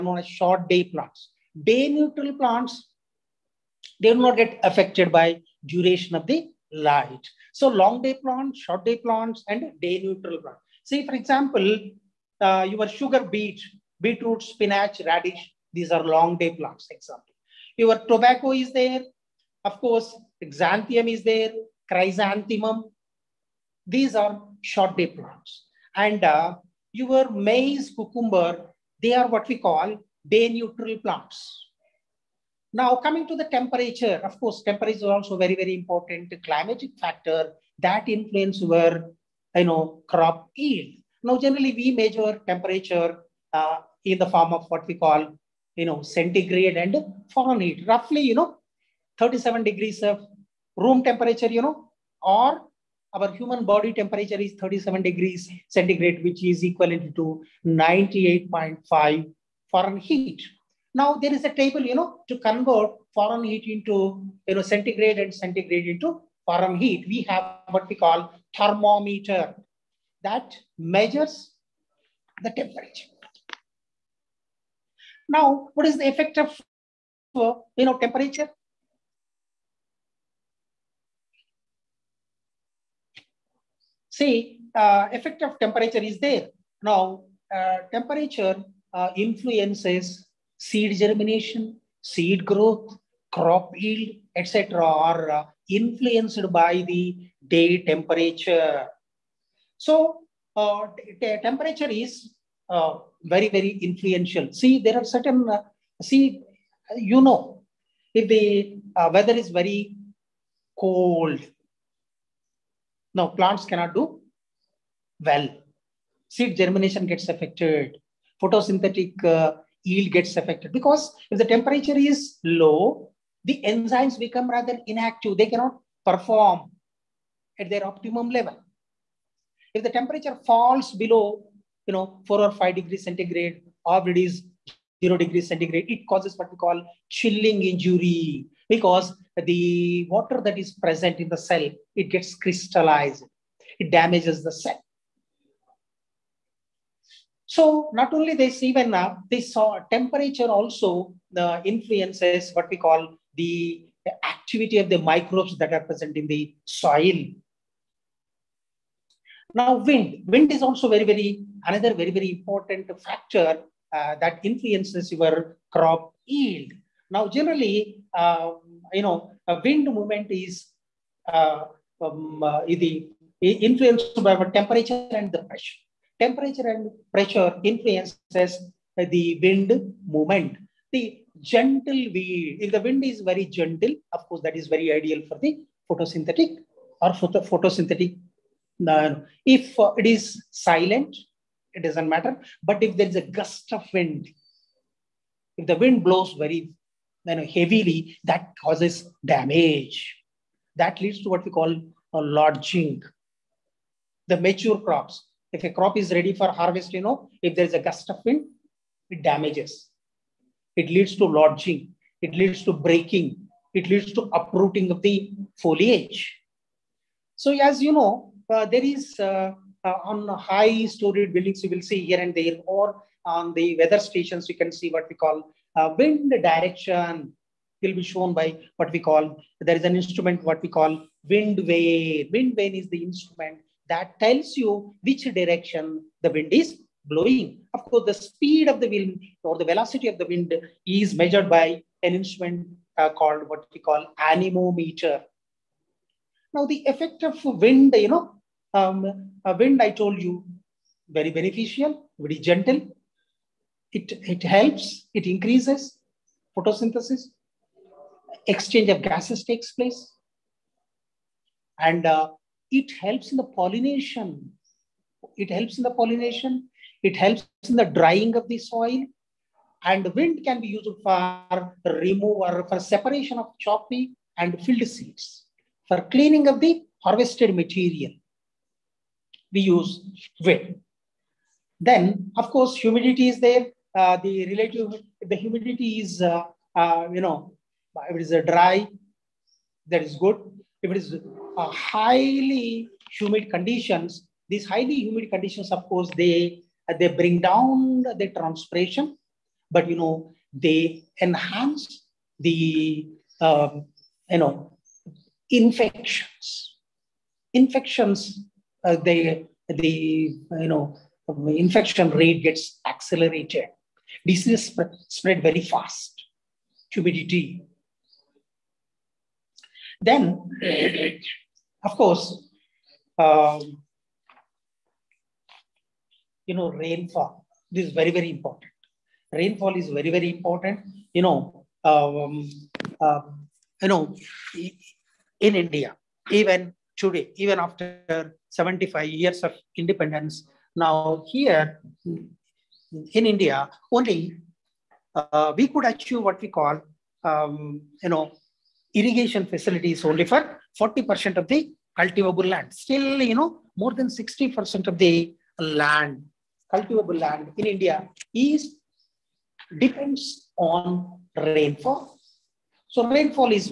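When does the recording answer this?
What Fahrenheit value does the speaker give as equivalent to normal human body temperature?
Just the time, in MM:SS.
00:57.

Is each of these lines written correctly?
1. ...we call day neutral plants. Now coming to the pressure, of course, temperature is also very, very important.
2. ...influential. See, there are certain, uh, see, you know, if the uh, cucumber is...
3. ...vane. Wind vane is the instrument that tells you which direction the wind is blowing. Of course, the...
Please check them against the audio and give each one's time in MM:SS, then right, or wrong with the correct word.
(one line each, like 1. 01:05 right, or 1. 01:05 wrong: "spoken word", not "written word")
1. 00:29 wrong: "temperature", not "pressure"
2. 01:43 wrong: "weather", not "cucumber"
3. 03:51 right.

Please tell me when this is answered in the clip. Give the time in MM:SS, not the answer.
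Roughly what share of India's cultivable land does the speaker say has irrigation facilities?
05:50.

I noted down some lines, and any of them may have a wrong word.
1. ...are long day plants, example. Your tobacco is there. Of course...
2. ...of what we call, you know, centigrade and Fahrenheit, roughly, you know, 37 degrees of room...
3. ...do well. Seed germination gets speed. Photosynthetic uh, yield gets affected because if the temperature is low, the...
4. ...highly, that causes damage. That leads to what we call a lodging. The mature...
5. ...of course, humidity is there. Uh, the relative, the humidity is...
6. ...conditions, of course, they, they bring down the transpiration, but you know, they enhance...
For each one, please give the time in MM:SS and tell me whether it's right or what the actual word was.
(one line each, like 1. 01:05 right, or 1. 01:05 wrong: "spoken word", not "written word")
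1. 00:15 right
2. 00:44 right
3. 01:53 wrong: "affected", not "speed"
4. 03:17 wrong: "heavily", not "highly"
5. 04:42 right
6. 04:55 right.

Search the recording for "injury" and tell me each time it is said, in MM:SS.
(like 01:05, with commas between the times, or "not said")
02:17.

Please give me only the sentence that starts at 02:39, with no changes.
Now wind, wind is also very, very, another very, very important factor uh, that influences your crop yield.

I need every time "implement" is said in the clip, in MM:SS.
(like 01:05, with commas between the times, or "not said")
not said.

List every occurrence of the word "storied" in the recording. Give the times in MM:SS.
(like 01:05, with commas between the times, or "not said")
03:40.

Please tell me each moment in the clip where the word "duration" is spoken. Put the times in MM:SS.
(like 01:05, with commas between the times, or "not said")
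00:05.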